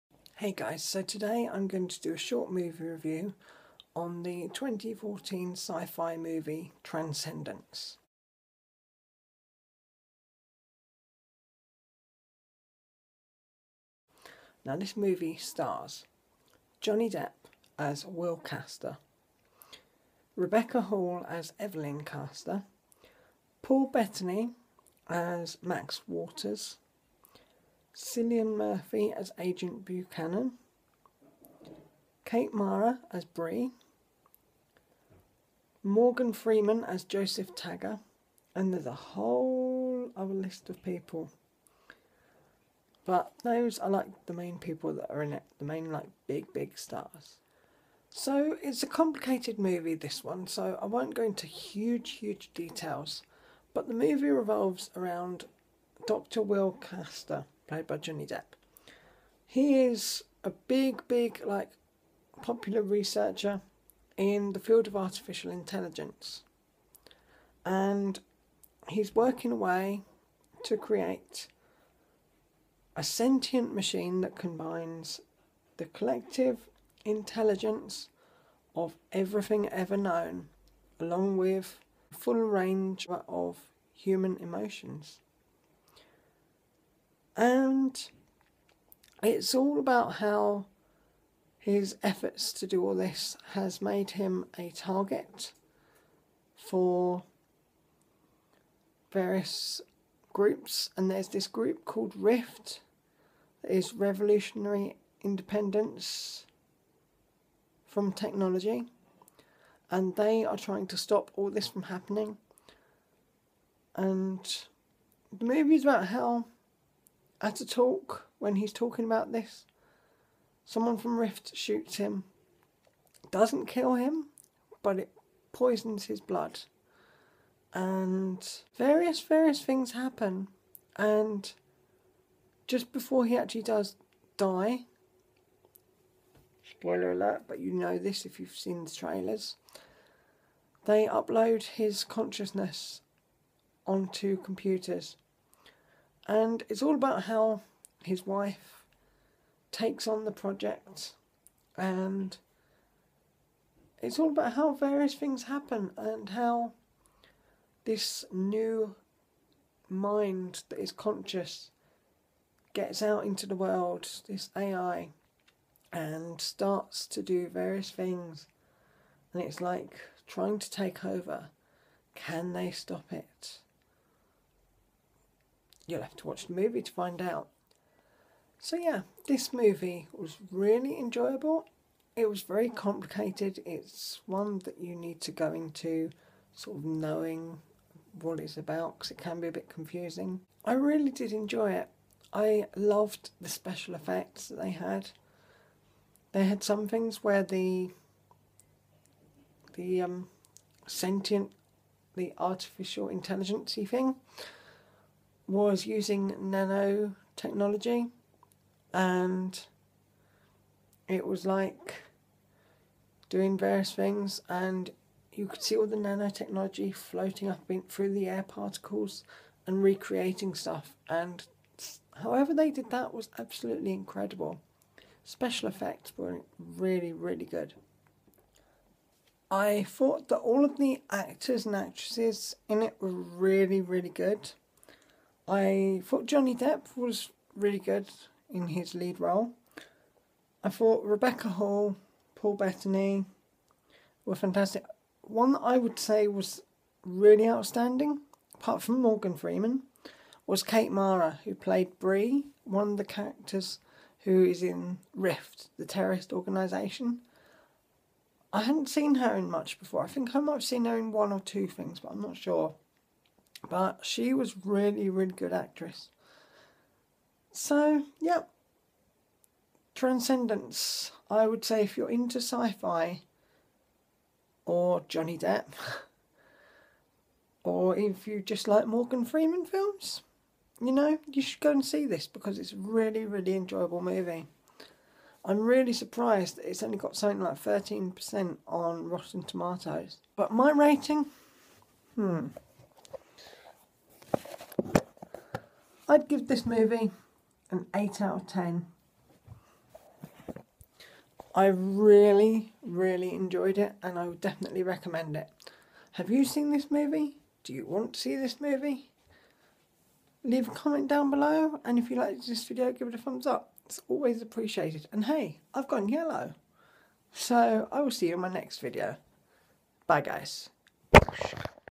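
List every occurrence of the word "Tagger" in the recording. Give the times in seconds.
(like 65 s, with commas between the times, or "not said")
37 s.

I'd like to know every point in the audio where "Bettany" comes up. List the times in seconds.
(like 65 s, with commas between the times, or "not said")
23 s, 242 s.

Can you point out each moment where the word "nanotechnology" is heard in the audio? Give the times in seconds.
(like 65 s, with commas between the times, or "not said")
206 s, 215 s.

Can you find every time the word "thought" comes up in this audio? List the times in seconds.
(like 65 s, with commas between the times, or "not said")
229 s, 236 s, 240 s.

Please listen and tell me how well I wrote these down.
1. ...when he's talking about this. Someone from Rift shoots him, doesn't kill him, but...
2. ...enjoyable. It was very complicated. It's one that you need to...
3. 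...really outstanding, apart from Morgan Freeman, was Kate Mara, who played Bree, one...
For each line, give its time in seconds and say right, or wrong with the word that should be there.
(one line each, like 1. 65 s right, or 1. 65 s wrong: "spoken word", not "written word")
1. 118 s right
2. 180 s right
3. 247 s right.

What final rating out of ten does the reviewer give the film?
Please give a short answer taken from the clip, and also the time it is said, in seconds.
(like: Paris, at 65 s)
8 out of 10, at 297 s.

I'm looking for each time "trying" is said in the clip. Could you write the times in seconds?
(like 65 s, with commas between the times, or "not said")
110 s, 170 s.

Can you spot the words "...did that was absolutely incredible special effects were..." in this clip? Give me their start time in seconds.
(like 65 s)
222 s.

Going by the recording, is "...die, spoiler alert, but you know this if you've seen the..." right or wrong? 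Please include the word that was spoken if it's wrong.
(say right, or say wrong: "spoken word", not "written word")
right.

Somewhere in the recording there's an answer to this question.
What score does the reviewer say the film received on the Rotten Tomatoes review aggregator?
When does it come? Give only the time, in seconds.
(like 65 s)
287 s.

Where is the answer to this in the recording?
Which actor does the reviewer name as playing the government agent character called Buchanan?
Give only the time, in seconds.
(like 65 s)
27 s.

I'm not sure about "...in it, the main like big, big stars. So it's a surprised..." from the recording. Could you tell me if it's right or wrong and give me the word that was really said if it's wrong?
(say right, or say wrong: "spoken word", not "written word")
wrong: "complicated", not "surprised".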